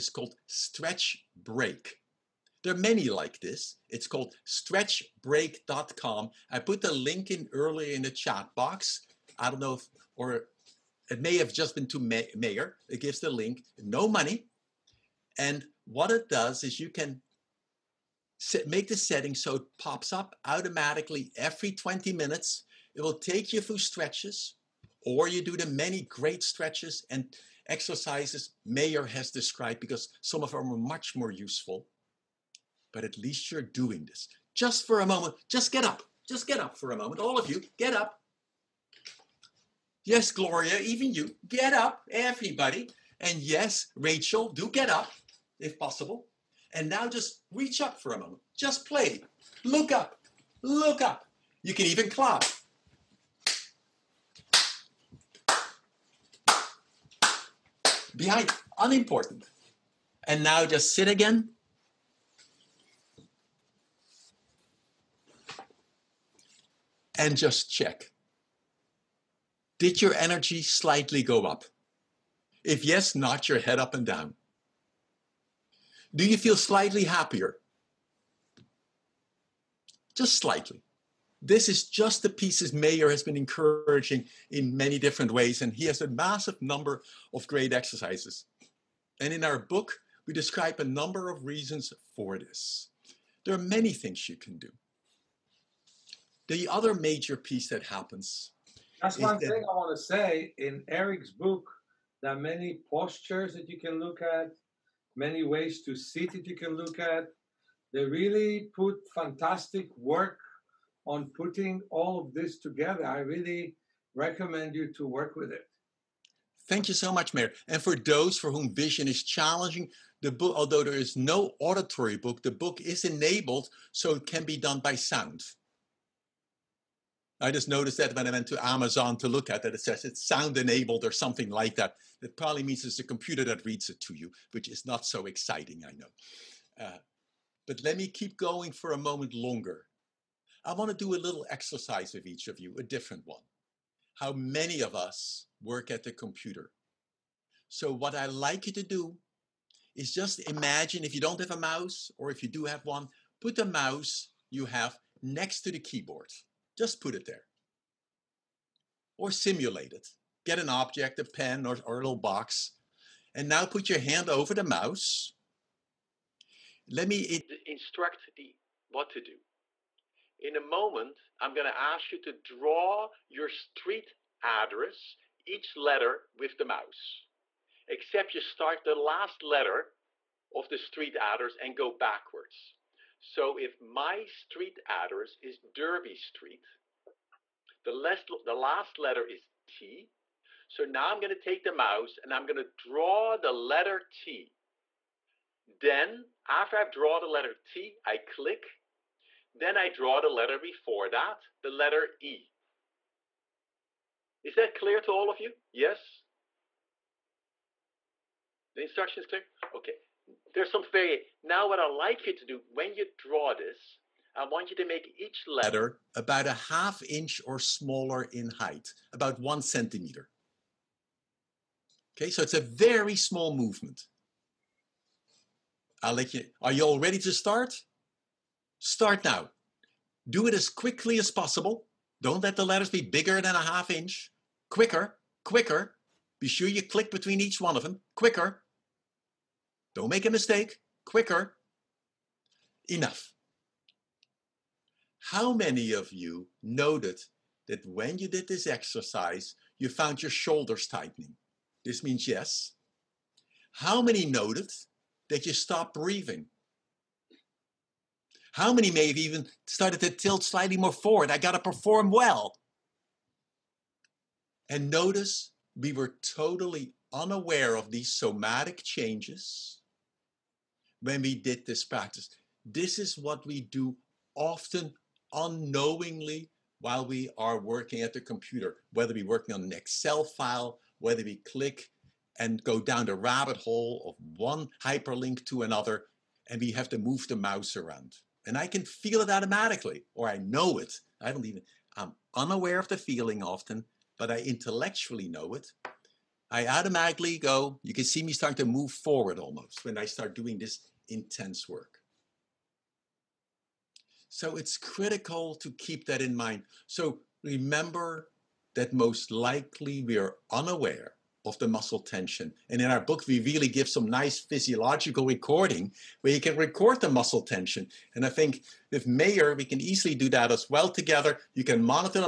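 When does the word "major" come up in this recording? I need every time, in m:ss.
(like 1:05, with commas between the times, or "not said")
1:36.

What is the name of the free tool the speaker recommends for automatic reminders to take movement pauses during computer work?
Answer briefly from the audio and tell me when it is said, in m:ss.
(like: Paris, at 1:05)
Stretch Break, at 0:00.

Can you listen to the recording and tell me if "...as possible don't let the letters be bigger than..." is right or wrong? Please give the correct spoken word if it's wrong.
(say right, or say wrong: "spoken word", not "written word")
right.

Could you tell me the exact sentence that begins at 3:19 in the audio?
Then I draw the letter before that, the letter E.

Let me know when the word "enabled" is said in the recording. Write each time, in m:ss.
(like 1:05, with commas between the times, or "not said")
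2:03, 2:10.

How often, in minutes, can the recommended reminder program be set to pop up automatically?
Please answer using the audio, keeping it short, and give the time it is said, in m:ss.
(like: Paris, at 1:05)
20, at 0:21.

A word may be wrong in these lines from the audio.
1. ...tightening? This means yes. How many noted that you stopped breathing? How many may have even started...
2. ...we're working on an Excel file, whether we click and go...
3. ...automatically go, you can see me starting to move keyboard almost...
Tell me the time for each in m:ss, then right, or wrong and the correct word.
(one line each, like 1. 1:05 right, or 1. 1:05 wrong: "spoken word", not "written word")
1. 4:10 right
2. 4:39 right
3. 4:56 wrong: "forward", not "keyboard".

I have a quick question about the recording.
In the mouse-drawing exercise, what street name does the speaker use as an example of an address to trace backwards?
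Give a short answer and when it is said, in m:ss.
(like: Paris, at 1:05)
Derby Street, at 3:05.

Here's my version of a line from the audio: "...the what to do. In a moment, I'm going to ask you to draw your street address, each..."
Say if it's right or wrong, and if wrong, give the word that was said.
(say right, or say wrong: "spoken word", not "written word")
right.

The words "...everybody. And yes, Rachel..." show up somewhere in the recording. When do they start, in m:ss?
0:42.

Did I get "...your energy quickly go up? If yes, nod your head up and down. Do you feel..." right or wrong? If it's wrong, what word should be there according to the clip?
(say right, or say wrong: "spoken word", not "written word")
wrong: "slightly", not "quickly".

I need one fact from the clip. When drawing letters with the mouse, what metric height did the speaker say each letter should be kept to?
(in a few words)
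1 centimeter.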